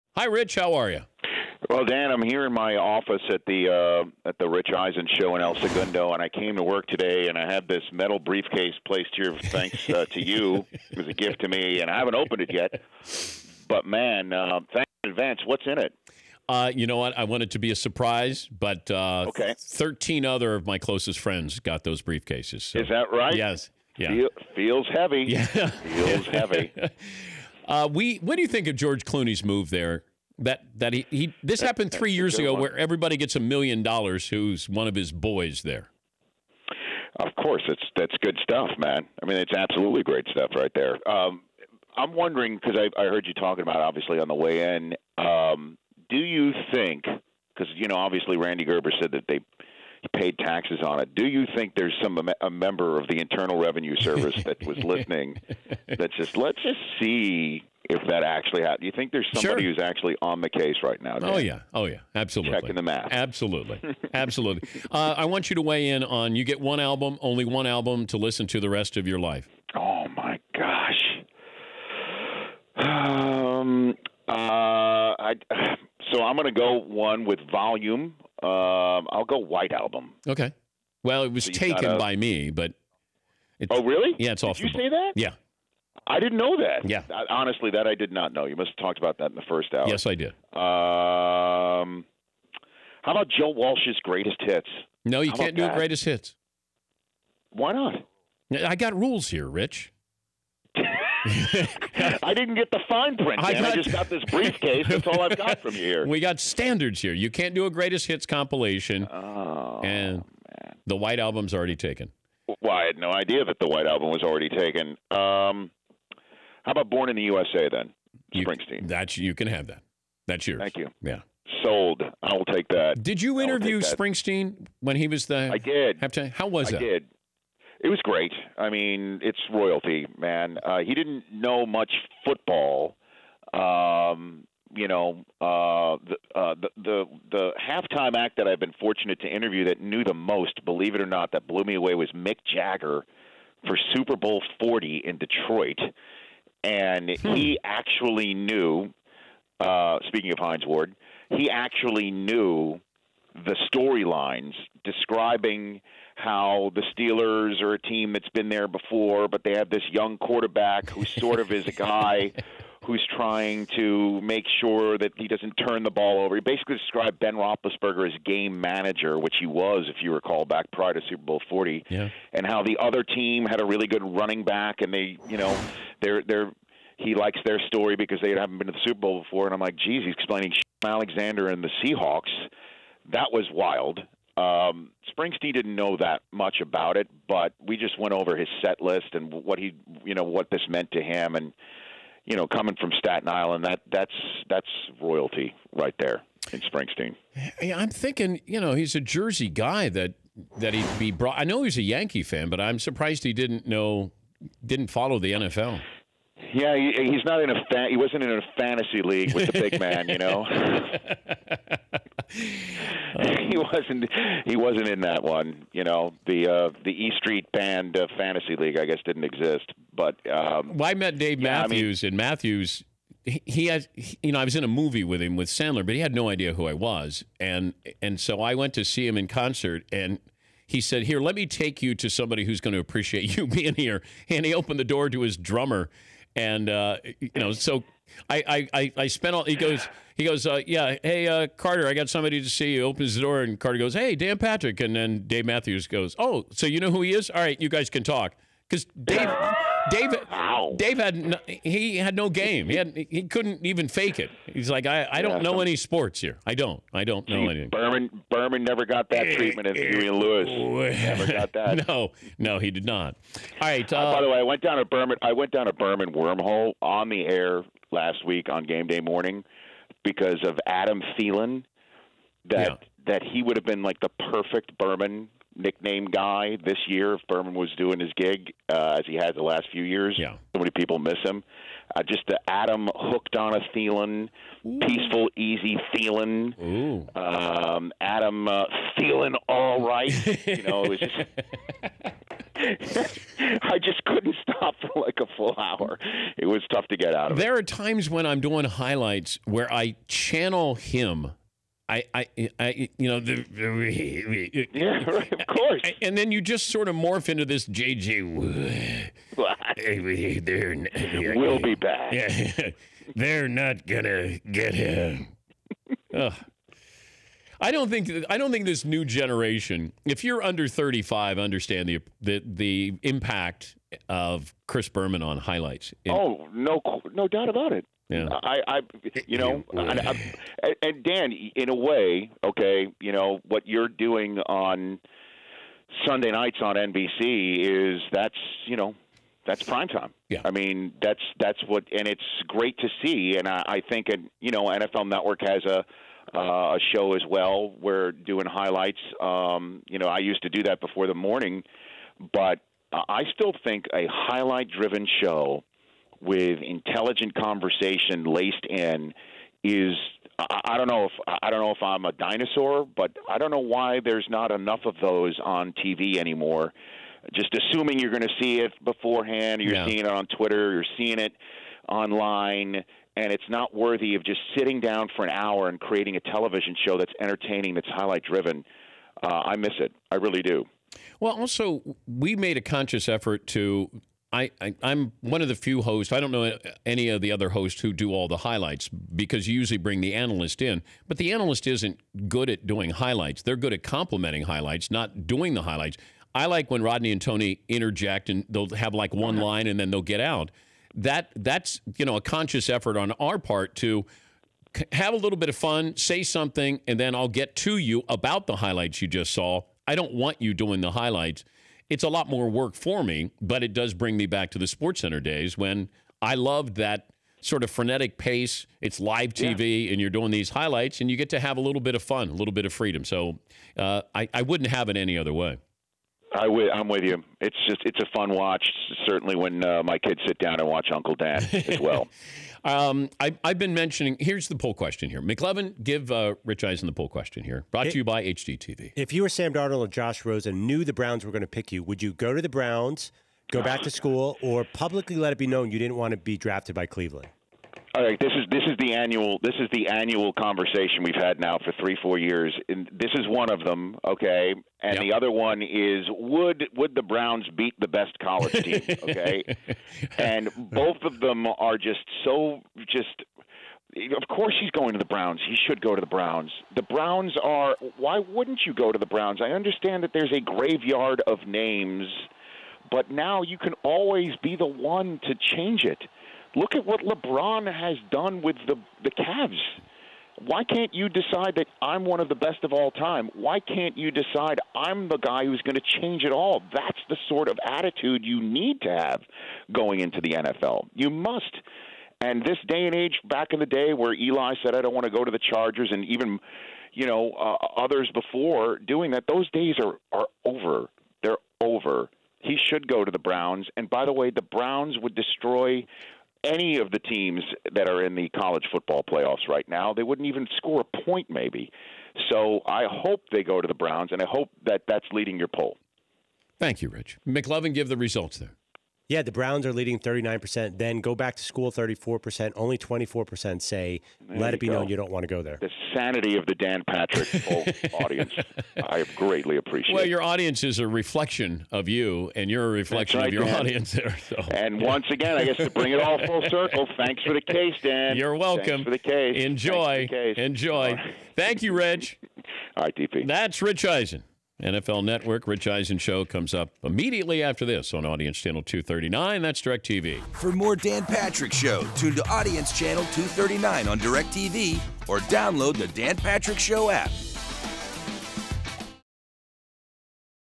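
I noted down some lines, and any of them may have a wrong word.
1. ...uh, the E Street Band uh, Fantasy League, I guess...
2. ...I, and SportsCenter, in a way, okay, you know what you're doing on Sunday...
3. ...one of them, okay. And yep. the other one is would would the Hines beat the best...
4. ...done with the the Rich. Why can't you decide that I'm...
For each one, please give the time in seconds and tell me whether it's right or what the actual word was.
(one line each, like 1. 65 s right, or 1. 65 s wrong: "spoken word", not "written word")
1. 216 s right
2. 330 s wrong: "Dan", not "SportsCenter"
3. 453 s wrong: "Browns", not "Hines"
4. 478 s wrong: "Cavs", not "Rich".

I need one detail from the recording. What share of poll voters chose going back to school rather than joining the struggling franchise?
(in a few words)
34%.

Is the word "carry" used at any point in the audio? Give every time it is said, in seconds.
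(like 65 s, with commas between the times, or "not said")
not said.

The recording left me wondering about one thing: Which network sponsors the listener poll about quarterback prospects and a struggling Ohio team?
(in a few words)
HGTV.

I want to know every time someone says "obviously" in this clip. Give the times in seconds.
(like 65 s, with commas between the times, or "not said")
43 s, 47 s.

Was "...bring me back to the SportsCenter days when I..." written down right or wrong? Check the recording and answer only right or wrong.
right.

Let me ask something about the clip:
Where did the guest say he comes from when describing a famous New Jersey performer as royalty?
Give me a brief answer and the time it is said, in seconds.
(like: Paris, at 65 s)
Staten Island, at 192 s.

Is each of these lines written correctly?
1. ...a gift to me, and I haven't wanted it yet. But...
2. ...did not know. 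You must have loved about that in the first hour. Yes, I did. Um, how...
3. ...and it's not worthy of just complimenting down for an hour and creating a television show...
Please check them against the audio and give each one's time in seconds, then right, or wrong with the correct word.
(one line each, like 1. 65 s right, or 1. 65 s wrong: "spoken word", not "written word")
1. 11 s wrong: "opened", not "wanted"
2. 87 s wrong: "talked", not "loved"
3. 373 s wrong: "sitting", not "complimenting".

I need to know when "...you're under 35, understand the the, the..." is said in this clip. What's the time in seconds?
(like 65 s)
320 s.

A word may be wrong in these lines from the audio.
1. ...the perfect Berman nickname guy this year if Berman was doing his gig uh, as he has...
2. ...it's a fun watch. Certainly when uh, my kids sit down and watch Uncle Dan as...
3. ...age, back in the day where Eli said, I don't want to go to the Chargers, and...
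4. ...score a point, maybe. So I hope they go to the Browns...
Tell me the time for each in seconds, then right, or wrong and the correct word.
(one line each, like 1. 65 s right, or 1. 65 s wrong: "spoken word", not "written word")
1. 273 s right
2. 427 s right
3. 492 s right
4. 510 s right.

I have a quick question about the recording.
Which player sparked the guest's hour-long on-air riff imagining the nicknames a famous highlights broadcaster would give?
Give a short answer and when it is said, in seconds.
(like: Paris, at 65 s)
Adam Thielen, at 270 s.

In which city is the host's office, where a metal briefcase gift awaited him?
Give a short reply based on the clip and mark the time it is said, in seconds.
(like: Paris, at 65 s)
El Segundo, at 5 s.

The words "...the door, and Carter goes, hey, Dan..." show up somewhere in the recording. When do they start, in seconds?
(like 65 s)
243 s.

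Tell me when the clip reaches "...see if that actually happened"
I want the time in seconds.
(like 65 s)
56 s.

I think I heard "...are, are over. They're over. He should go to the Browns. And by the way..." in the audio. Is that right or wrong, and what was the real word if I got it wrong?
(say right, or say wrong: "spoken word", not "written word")
right.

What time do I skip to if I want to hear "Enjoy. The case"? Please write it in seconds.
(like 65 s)
539 s.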